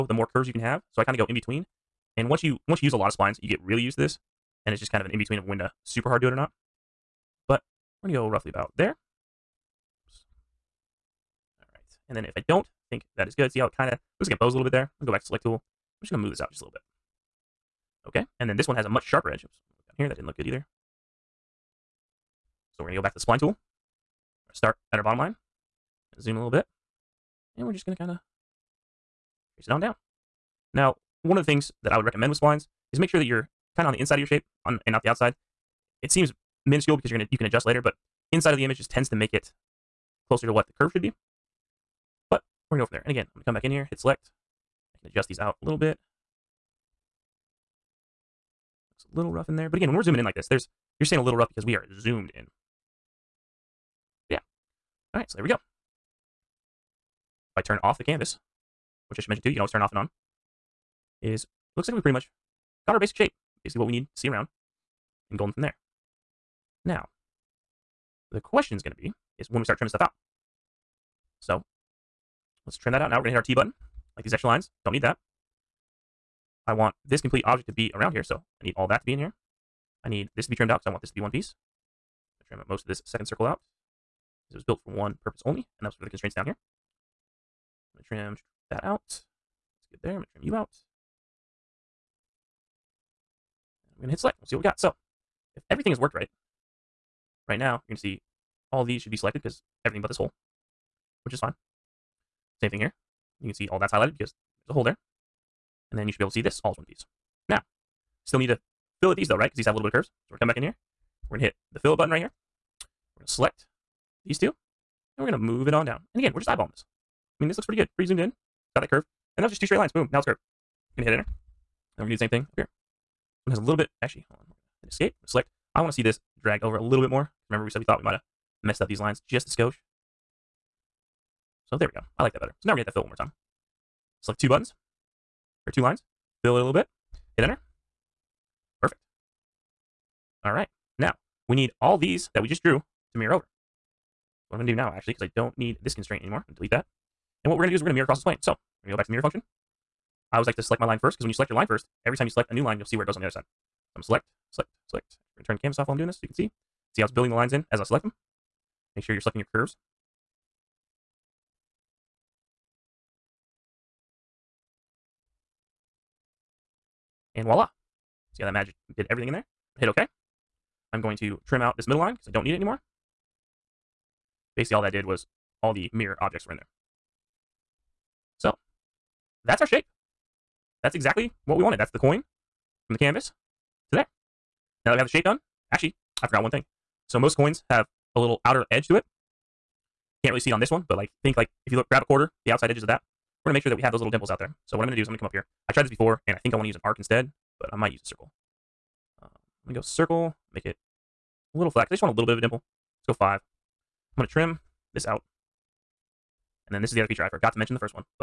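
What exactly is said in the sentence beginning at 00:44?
I can adjust these out a little bit.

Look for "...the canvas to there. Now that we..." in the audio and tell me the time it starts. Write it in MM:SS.
03:02.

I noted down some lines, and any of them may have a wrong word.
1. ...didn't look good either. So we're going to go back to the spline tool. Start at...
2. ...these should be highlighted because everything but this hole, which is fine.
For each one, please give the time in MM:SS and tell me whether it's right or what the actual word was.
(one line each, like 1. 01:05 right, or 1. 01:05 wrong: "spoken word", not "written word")
1. 00:20 right
2. 01:38 wrong: "selected", not "highlighted".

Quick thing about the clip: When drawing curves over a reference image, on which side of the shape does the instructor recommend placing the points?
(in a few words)
The inside.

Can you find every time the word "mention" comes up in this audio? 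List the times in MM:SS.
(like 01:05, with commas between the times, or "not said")
00:59, 03:27.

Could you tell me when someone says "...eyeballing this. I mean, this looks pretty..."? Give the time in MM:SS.
01:56.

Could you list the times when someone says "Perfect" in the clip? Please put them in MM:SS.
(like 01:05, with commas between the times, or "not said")
02:18.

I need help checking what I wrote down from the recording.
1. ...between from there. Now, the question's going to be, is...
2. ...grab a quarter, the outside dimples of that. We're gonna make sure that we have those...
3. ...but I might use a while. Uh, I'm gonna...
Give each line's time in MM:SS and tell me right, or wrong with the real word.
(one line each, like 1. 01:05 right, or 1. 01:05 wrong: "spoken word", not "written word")
1. 01:05 wrong: "golden", not "between"
2. 03:11 wrong: "edges", not "dimples"
3. 03:17 wrong: "circle", not "while".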